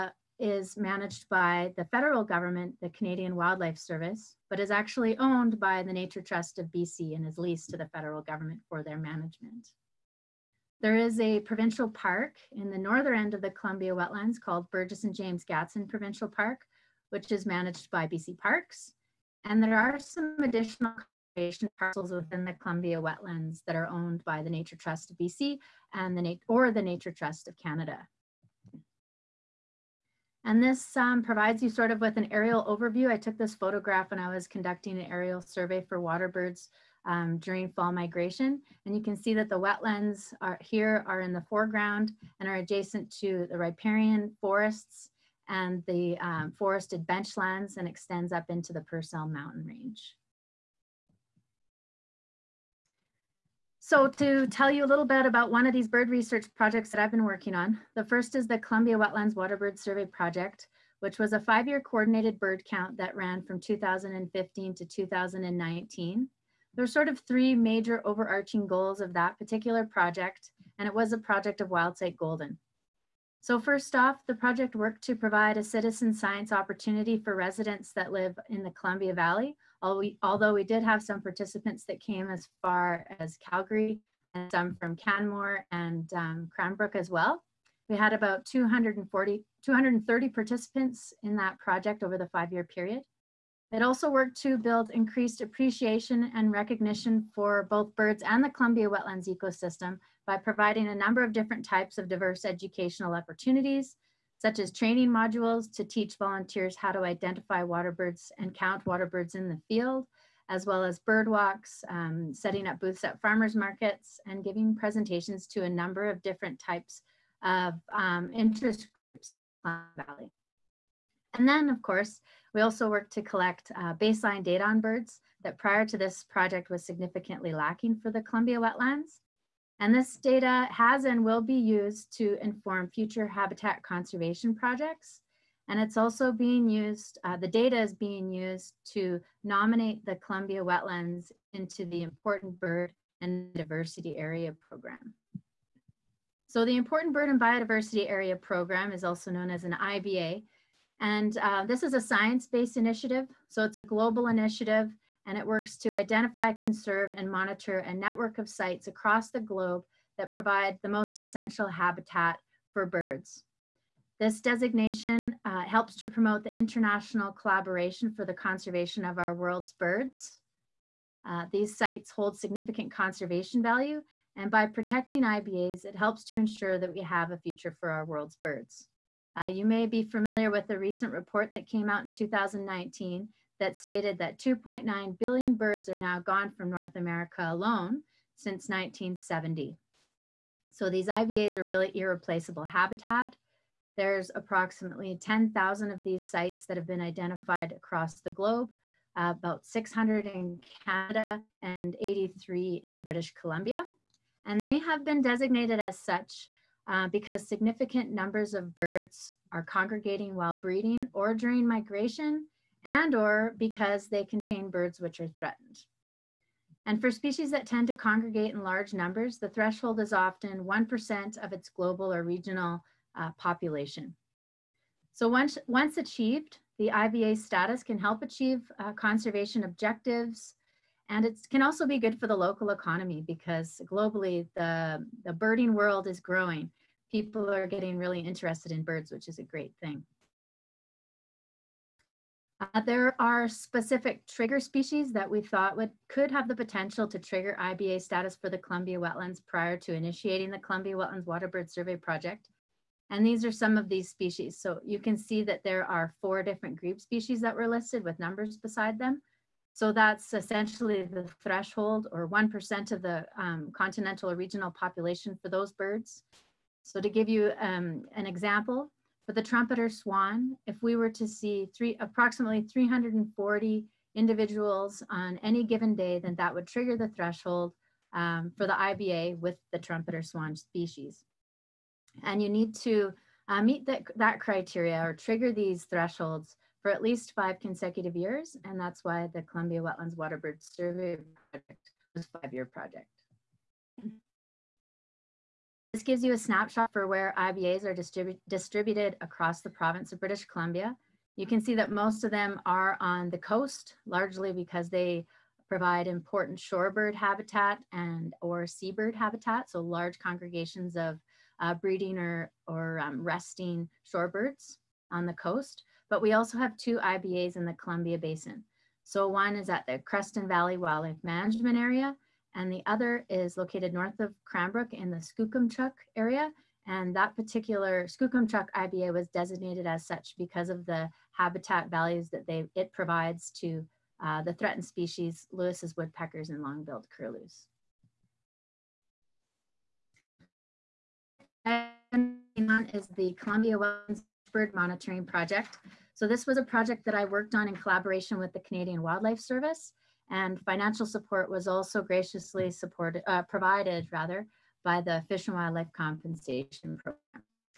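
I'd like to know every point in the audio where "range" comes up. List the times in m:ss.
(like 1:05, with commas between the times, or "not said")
0:49.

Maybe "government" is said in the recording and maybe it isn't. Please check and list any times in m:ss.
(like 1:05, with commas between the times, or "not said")
0:02, 0:08.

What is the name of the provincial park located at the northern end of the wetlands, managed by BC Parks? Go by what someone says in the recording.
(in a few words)
Burges and James Gadsden Provincial Park.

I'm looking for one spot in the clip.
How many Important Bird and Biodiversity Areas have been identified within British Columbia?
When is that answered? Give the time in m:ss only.
3:21.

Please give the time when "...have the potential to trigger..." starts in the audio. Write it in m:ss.
4:06.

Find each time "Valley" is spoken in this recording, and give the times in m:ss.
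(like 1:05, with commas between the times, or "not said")
1:19, 2:00, 5:20.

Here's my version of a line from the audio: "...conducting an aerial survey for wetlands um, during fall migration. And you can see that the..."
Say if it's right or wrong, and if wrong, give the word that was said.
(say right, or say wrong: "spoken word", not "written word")
wrong: "waterbirds", not "wetlands".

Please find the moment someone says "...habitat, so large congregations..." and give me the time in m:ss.
5:09.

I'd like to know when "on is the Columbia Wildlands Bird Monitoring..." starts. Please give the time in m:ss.
5:41.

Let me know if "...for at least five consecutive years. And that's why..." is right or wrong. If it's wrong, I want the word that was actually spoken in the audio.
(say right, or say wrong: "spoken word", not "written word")
right.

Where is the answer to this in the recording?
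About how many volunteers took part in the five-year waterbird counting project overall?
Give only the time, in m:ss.
1:29.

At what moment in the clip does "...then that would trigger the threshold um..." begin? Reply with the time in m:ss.
4:36.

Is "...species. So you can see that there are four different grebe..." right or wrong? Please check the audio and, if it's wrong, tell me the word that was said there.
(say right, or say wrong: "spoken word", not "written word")
right.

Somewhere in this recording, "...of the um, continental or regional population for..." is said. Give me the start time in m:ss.
4:22.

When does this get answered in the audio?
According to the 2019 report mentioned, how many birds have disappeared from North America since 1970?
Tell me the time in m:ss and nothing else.
3:04.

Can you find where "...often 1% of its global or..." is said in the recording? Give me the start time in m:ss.
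3:40.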